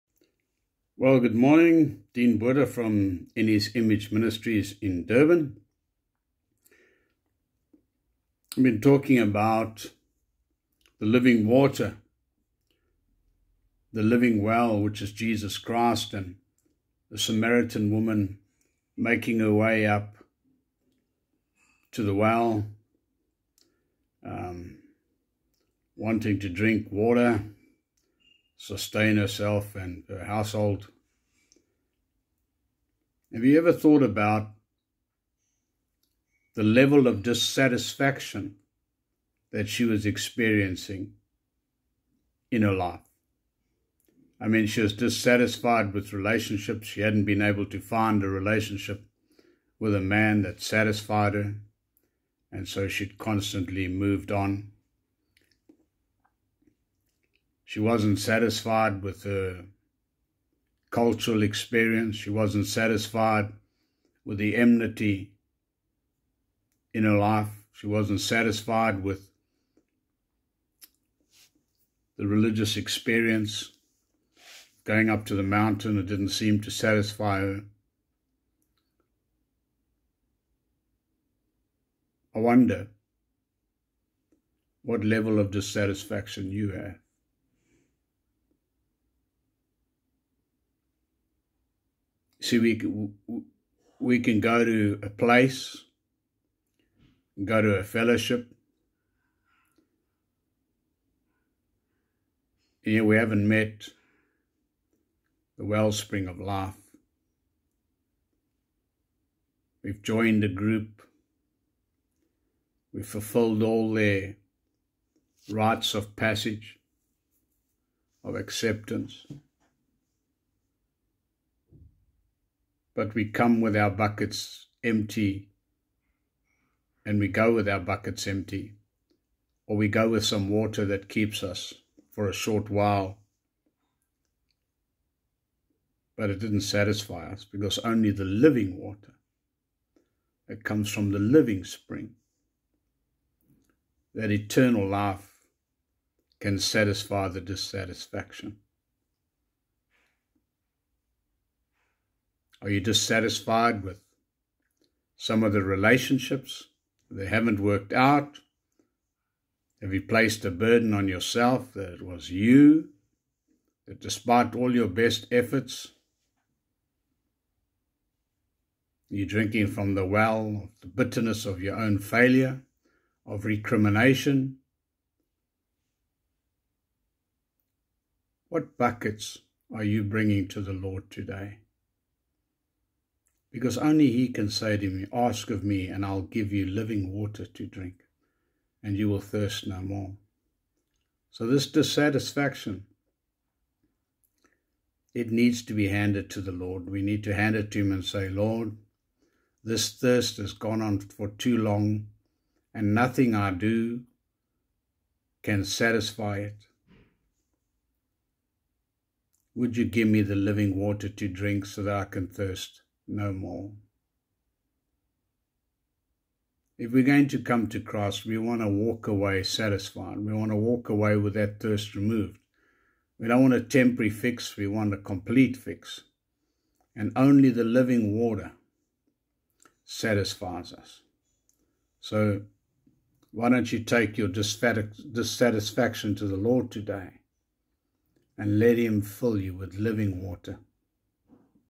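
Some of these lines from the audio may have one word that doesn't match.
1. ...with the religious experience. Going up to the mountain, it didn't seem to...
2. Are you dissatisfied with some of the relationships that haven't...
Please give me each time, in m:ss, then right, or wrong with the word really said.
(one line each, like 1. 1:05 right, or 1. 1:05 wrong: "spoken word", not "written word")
1. 1:09 right
2. 2:32 right.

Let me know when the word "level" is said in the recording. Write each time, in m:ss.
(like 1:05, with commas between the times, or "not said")
0:36, 1:25.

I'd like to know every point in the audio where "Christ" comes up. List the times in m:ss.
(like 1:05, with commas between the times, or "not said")
0:15, 3:37.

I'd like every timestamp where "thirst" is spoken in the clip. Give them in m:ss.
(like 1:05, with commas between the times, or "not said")
3:09, 3:19, 3:32, 3:41.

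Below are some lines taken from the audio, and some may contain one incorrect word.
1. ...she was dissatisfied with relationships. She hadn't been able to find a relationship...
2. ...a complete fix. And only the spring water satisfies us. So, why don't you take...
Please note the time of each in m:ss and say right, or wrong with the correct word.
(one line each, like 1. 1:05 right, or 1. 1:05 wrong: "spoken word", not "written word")
1. 0:44 right
2. 3:44 wrong: "living", not "spring".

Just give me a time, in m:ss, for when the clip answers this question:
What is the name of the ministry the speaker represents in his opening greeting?
0:03.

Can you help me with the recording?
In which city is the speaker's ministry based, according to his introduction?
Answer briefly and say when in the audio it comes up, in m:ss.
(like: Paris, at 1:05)
Durban, at 0:05.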